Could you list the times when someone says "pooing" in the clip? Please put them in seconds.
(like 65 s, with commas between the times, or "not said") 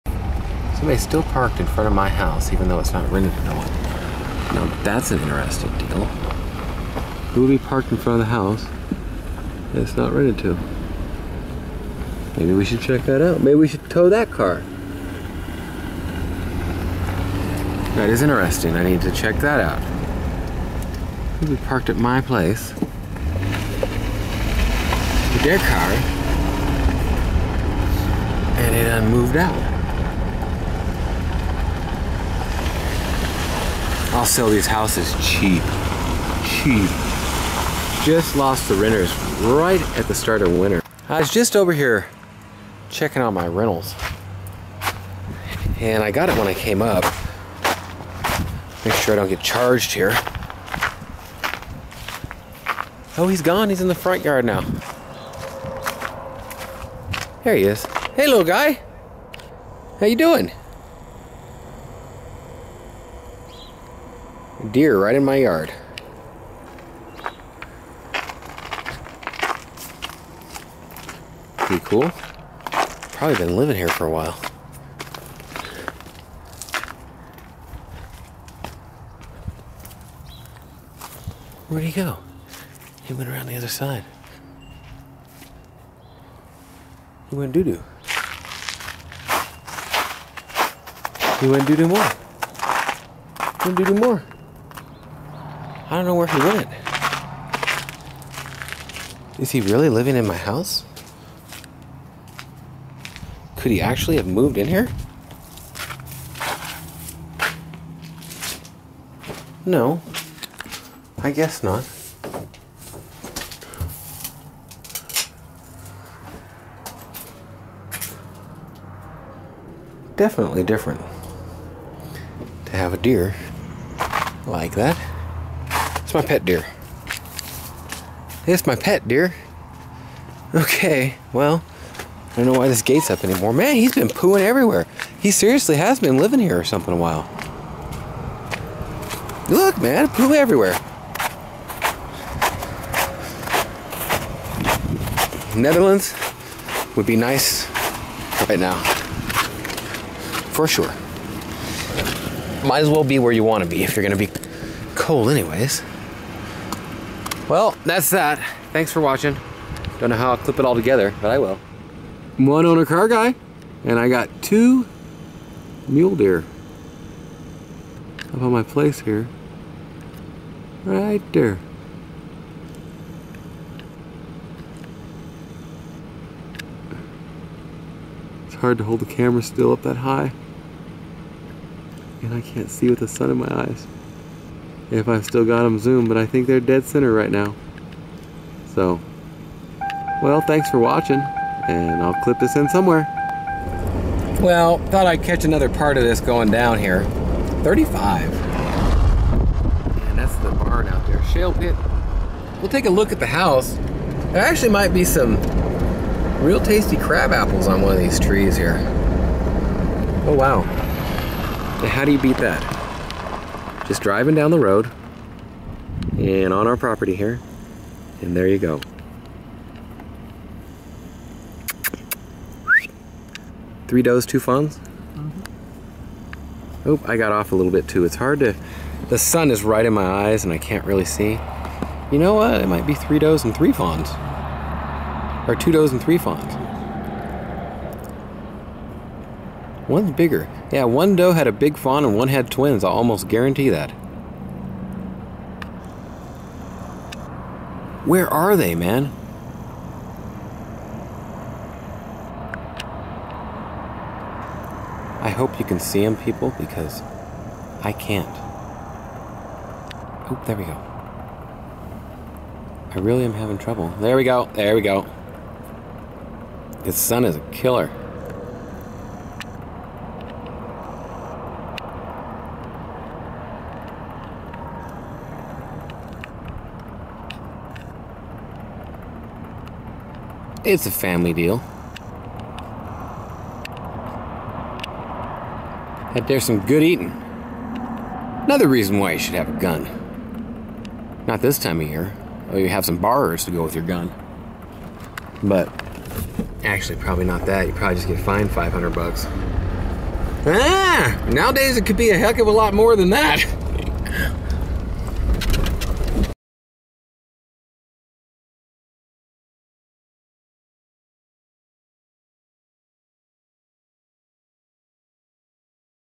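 134 s.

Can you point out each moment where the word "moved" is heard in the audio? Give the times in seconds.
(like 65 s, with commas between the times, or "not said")
29 s, 104 s.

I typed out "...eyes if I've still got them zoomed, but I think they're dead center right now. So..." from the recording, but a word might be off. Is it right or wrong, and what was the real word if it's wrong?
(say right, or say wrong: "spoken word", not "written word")
right.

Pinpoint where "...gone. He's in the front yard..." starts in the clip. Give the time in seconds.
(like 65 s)
53 s.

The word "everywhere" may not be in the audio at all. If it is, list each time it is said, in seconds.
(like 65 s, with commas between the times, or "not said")
134 s, 140 s.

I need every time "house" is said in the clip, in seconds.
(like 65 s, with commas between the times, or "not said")
2 s, 8 s, 34 s, 100 s, 203 s.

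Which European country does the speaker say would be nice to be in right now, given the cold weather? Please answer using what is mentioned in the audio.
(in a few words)
Netherlands.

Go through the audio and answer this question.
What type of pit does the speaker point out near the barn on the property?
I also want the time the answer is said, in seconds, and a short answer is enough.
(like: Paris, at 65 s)
shale pit, at 201 s.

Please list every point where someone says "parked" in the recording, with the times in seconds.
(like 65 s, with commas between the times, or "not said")
1 s, 7 s, 21 s.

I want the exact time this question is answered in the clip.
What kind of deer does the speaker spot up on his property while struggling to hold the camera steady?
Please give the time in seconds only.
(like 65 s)
165 s.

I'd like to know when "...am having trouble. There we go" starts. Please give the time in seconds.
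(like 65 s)
263 s.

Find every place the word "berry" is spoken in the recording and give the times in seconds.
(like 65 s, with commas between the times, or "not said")
not said.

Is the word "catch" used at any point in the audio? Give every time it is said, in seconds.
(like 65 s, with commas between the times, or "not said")
195 s.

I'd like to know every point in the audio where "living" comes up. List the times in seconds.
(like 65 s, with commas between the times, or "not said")
73 s, 99 s, 136 s.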